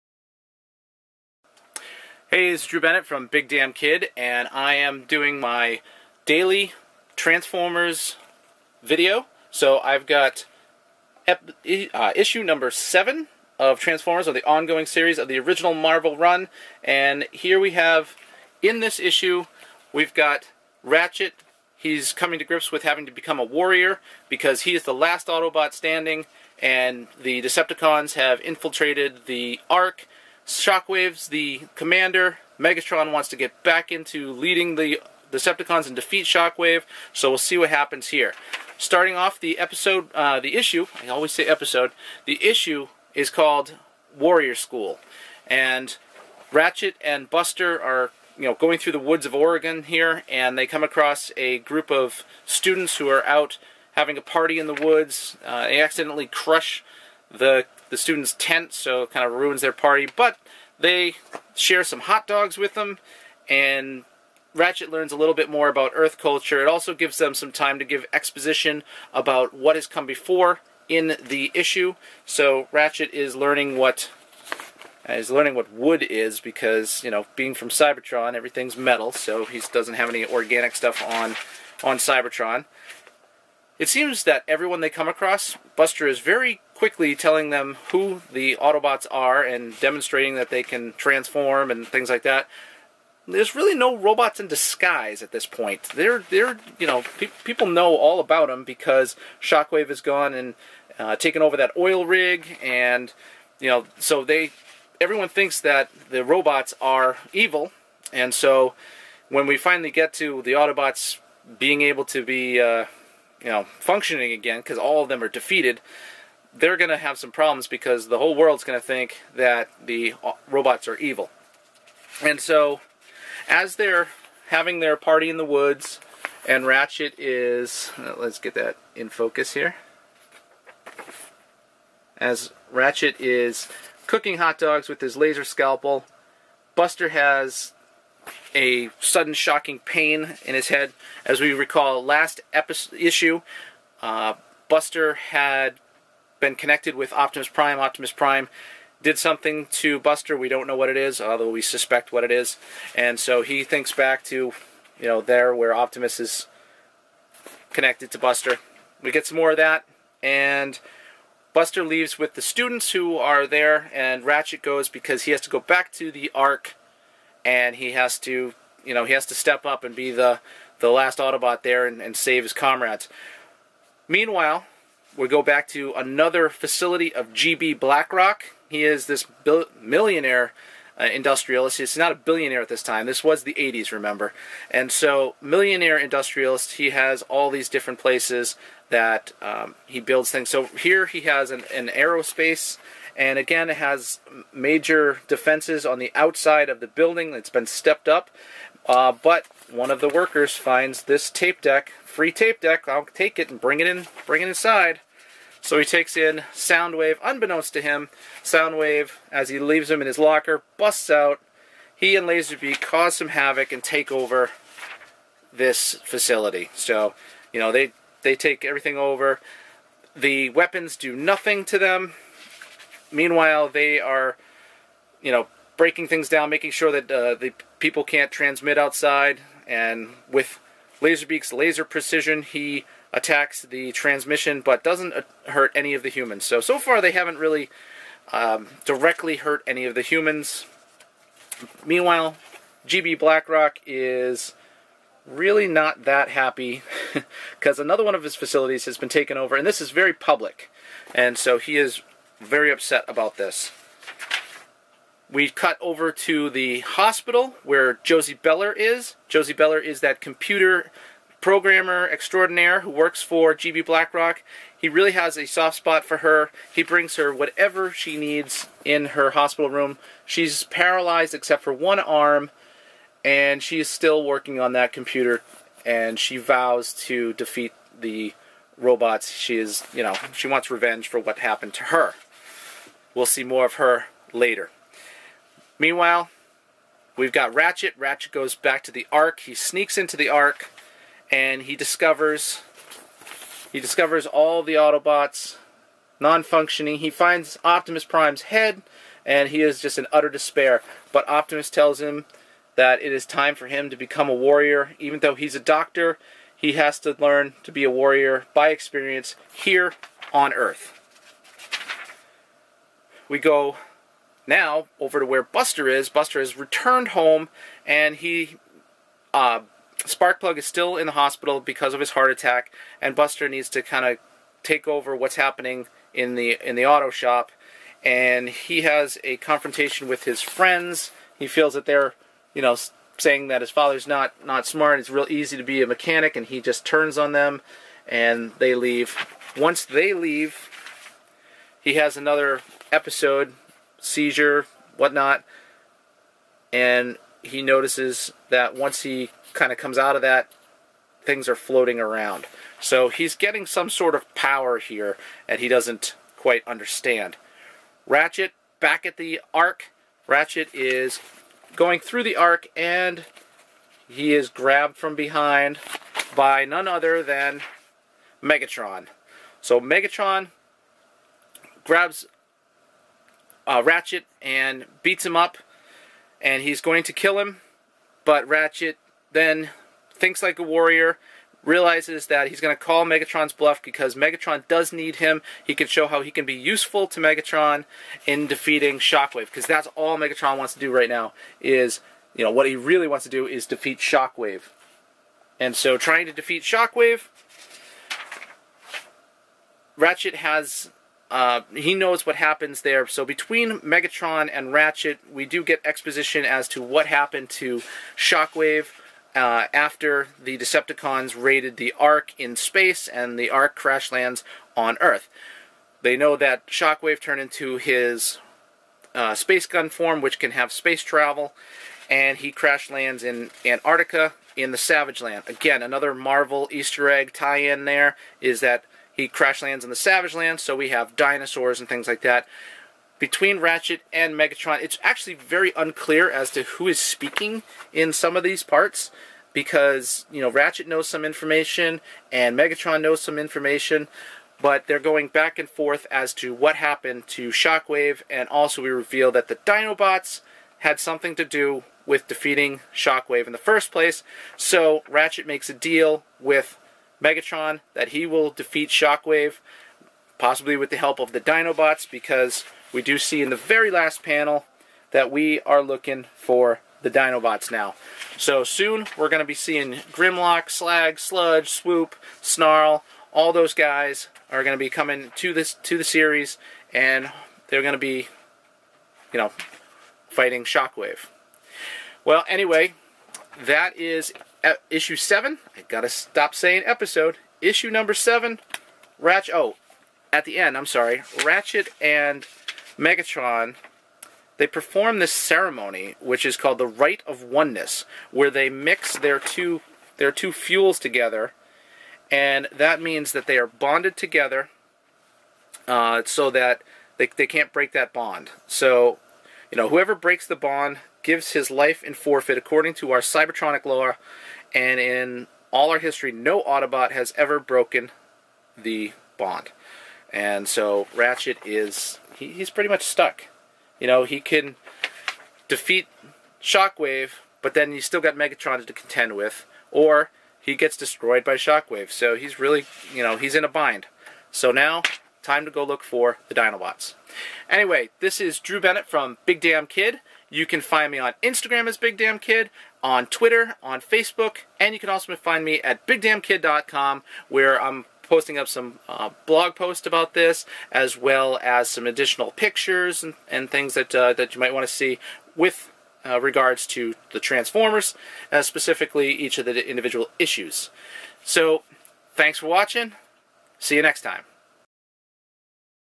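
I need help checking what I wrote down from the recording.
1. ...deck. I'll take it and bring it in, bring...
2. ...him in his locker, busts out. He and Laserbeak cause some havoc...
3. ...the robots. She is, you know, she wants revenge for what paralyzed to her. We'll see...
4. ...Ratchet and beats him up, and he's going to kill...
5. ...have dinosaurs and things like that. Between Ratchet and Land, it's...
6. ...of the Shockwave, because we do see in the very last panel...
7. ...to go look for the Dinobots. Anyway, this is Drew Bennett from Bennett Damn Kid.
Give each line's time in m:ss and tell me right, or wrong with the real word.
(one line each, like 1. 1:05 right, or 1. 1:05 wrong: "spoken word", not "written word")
1. 3:22 right
2. 3:29 right
3. 4:37 wrong: "happened", not "paralyzed"
4. 6:13 right
5. 7:10 wrong: "Megatron", not "Land"
6. 7:41 wrong: "Dinobots", not "Shockwave"
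7. 8:55 wrong: "Big", not "Bennett".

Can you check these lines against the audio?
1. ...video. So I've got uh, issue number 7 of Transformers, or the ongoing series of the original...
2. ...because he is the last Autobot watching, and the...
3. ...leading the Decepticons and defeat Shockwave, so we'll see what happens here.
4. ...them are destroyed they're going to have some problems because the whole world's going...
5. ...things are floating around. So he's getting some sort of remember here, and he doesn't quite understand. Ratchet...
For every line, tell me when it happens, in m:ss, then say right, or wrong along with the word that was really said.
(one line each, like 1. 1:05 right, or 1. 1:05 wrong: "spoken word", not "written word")
1. 0:08 right
2. 0:24 wrong: "standing", not "watching"
3. 0:34 right
4. 1:55 wrong: "defeated", not "destroyed"
5. 5:51 wrong: "power", not "remember".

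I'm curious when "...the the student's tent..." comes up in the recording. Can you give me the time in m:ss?
0:57.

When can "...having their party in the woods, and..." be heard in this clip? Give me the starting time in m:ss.
2:04.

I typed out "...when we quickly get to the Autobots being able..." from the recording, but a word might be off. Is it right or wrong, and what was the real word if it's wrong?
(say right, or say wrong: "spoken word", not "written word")
wrong: "finally", not "quickly".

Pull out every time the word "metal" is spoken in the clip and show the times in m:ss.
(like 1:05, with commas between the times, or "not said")
1:18.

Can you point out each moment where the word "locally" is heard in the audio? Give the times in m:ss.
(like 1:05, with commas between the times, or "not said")
not said.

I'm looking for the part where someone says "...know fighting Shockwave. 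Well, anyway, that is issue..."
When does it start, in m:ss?
7:59.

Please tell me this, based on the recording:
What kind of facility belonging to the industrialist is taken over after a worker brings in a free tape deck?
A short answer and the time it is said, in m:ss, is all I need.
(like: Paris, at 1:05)
Aerospace, at 3:11.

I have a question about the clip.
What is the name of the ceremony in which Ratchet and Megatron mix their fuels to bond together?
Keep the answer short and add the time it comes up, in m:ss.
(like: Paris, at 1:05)
Rite of Oneness, at 8:16.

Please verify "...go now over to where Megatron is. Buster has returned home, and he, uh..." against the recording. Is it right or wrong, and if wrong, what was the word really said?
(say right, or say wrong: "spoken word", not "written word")
wrong: "Buster", not "Megatron".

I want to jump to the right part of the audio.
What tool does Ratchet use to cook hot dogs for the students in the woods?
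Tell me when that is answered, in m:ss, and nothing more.
2:15.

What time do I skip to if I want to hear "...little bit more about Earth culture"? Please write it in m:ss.
1:05.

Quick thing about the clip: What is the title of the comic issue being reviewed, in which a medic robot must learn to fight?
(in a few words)
Warrior School.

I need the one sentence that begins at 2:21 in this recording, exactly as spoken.
As we recall, last episode, issue, uh, Buster had been connected with Optimus Prime.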